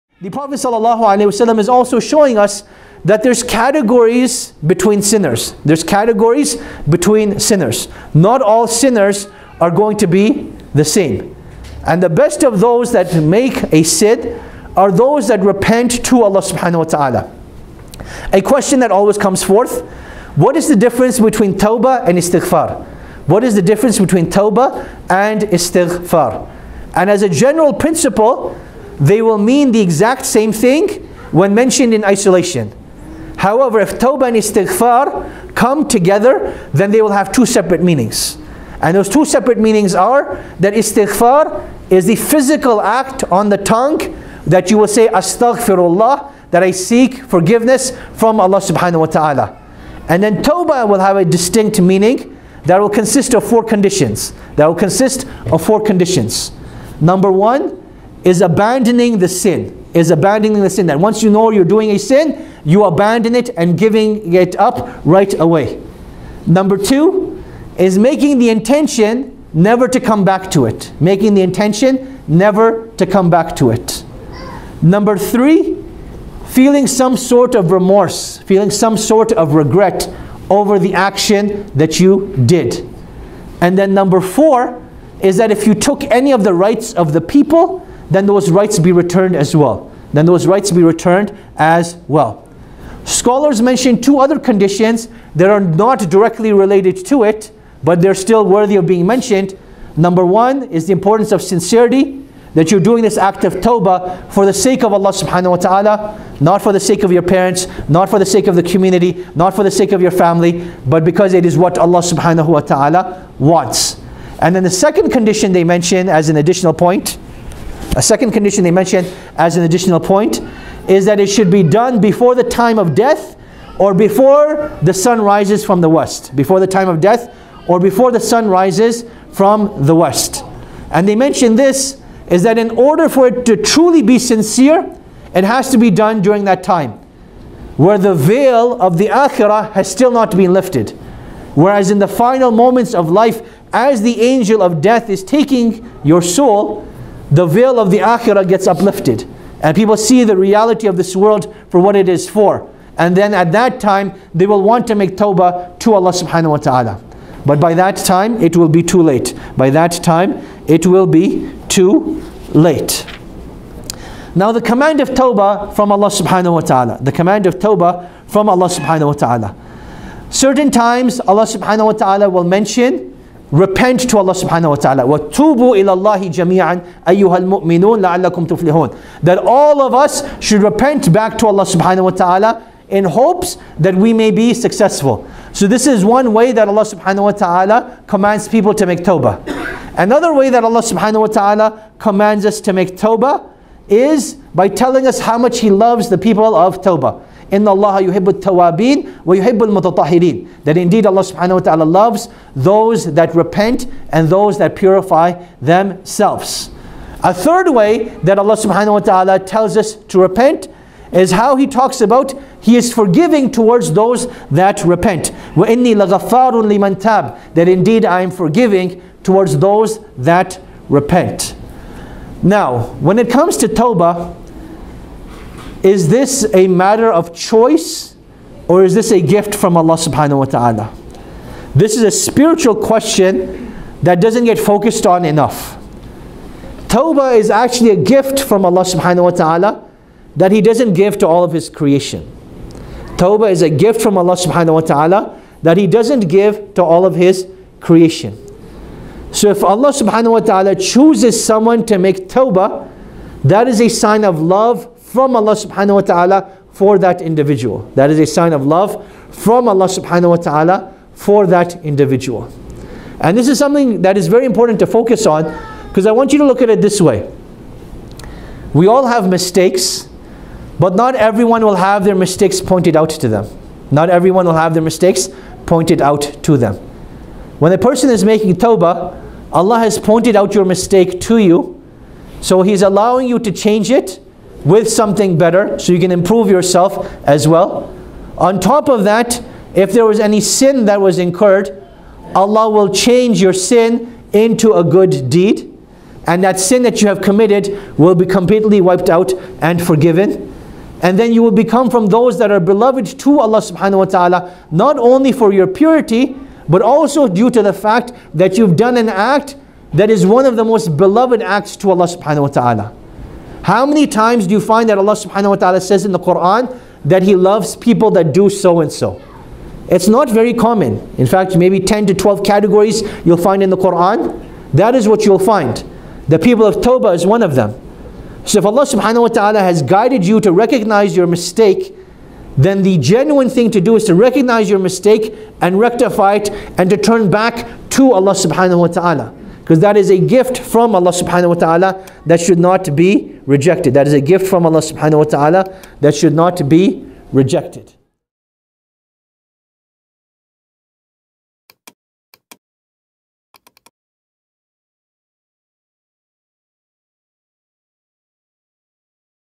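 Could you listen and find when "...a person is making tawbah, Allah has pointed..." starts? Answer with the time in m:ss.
4:37.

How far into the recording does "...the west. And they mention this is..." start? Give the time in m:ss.
2:09.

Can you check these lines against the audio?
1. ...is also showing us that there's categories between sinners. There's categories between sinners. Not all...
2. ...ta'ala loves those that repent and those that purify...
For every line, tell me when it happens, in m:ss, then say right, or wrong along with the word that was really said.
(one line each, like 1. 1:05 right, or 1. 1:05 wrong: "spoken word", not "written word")
1. 0:01 right
2. 3:21 right.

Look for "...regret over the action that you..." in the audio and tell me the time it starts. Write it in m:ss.
1:19.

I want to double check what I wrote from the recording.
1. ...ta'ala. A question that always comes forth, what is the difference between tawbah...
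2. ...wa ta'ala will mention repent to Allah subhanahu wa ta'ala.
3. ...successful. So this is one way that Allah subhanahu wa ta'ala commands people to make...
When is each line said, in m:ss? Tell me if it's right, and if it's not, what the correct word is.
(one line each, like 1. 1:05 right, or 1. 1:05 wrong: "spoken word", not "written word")
1. 0:16 right
2. 2:51 right
3. 3:04 right.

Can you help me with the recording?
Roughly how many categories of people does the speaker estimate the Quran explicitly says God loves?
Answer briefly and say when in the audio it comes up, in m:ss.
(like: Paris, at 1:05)
10 to 12, at 5:21.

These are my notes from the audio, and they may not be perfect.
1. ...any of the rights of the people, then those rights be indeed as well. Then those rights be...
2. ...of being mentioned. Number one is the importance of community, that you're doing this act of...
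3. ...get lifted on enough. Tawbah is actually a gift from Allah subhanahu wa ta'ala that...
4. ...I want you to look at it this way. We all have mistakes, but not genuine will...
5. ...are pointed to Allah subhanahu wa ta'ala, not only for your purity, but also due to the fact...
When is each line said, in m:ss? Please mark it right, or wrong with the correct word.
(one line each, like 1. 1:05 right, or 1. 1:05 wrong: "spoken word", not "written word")
1. 1:26 wrong: "returned", not "indeed"
2. 1:38 wrong: "sincerity", not "community"
3. 3:54 wrong: "focused", not "lifted"
4. 4:26 wrong: "everyone", not "genuine"
5. 5:02 wrong: "beloved", not "pointed".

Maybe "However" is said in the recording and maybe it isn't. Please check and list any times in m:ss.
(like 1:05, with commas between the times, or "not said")
0:33.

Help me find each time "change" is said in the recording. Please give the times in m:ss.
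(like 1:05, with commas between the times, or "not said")
4:43, 4:52.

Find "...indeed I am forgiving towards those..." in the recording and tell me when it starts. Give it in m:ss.
3:37.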